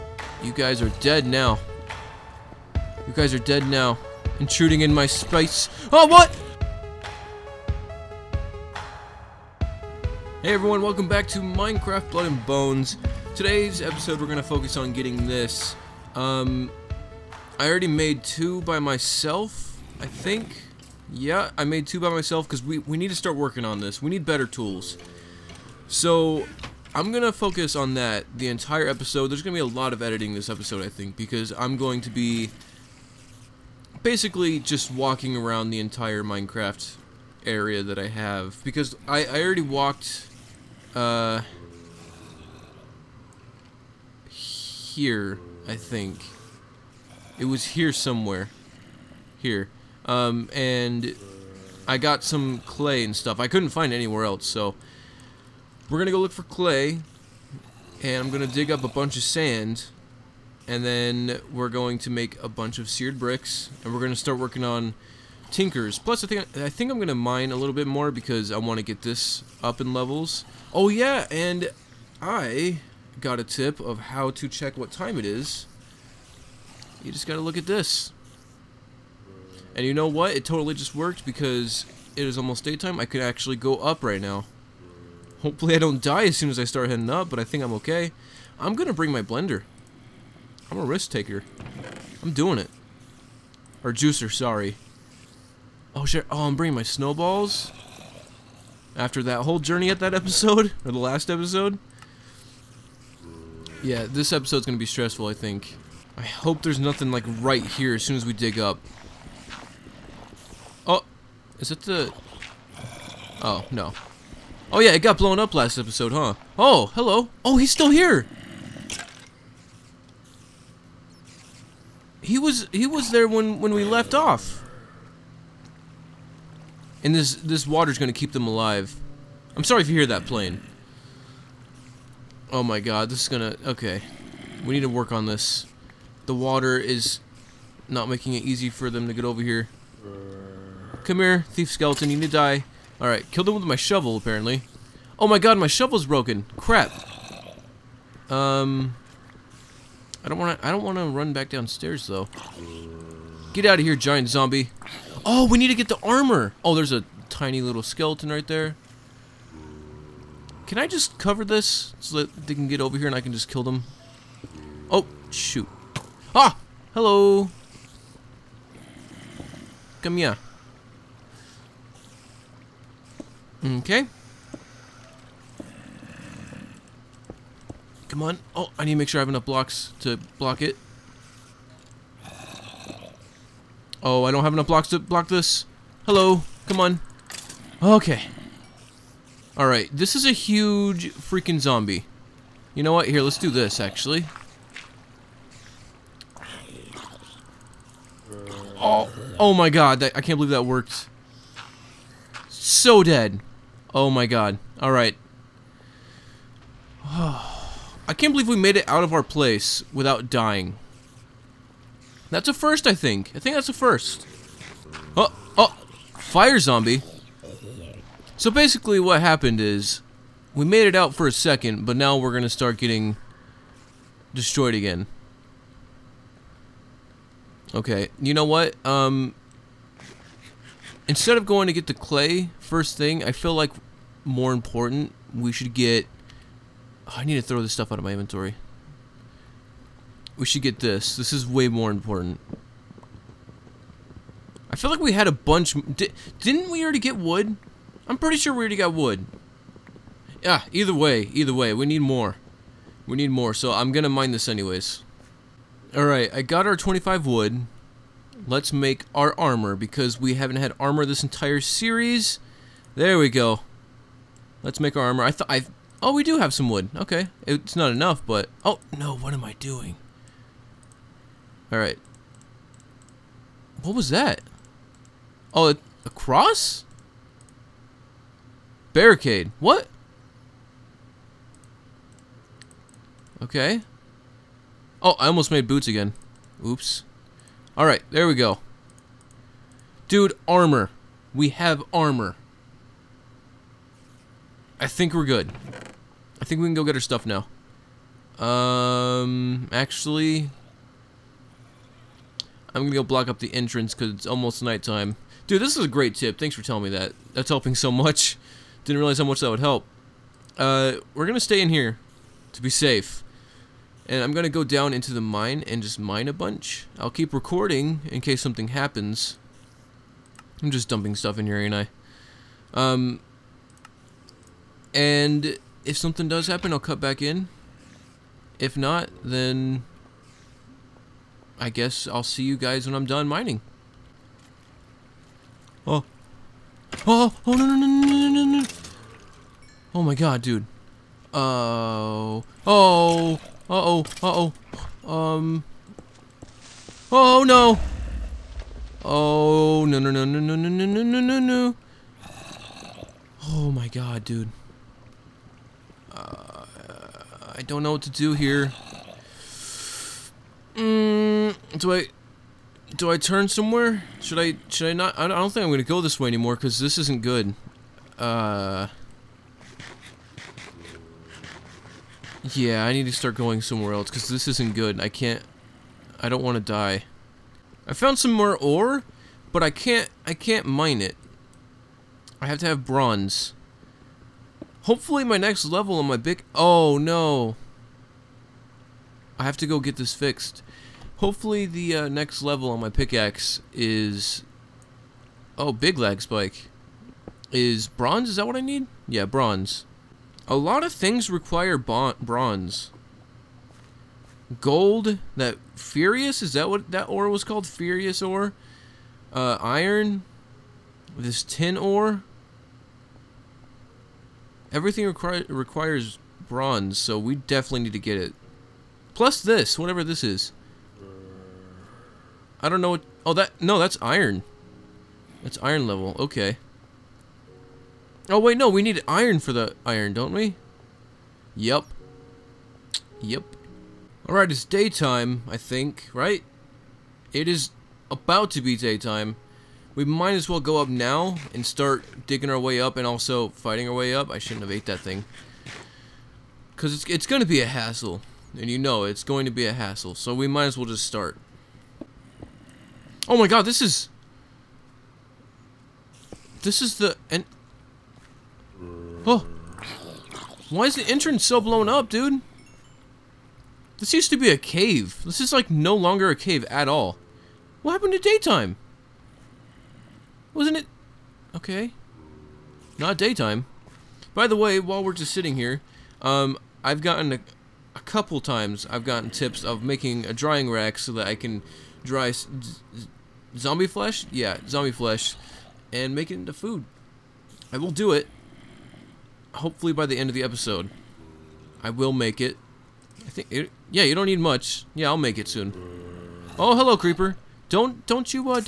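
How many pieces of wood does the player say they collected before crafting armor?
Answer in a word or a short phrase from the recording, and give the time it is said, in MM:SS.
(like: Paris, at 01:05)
25, at 04:16.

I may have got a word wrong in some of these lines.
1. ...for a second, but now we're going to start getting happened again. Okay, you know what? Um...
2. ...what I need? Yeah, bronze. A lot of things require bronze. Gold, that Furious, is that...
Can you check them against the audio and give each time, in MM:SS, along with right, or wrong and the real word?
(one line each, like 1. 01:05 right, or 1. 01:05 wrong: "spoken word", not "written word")
1. 03:41 wrong: "destroyed", not "happened"
2. 06:38 right.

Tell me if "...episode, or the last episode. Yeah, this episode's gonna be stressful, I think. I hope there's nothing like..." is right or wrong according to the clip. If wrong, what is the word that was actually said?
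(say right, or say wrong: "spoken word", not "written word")
right.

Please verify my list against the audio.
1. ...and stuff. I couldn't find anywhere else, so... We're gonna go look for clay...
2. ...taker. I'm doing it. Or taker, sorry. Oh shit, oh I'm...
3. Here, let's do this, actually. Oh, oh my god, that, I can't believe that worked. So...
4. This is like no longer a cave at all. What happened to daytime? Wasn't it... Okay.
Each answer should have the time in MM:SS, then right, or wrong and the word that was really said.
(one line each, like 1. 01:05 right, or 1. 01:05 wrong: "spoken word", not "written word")
1. 00:53 right
2. 01:31 wrong: "juicer", not "taker"
3. 03:13 right
4. 07:45 right.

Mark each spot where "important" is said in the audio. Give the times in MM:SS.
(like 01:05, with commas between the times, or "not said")
03:54, 04:01.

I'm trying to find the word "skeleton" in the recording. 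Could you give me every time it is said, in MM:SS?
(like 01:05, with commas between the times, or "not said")
02:21, 02:37.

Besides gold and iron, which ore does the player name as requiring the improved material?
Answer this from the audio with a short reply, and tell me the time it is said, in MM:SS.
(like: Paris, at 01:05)
Tin ore, at 06:51.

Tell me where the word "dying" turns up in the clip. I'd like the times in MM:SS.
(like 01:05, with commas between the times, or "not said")
03:30.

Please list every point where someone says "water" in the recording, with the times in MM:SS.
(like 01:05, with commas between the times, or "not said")
02:07, 02:16.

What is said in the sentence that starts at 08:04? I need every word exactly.
Yeah, zombie flesh, and make it into food.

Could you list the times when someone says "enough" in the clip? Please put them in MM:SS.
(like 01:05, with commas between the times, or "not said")
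02:59, 03:04, 04:27.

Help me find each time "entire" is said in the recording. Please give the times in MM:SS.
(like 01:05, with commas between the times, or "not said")
00:28, 00:35, 04:21.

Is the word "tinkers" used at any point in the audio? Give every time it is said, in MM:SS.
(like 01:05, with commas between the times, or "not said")
01:05.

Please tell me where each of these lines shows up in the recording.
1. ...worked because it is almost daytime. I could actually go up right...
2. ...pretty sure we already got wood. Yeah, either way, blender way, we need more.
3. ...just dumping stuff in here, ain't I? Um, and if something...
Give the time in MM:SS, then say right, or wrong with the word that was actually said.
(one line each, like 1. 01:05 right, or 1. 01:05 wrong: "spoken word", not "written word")
1. 01:20 right
2. 04:08 wrong: "either", not "blender"
3. 05:20 right.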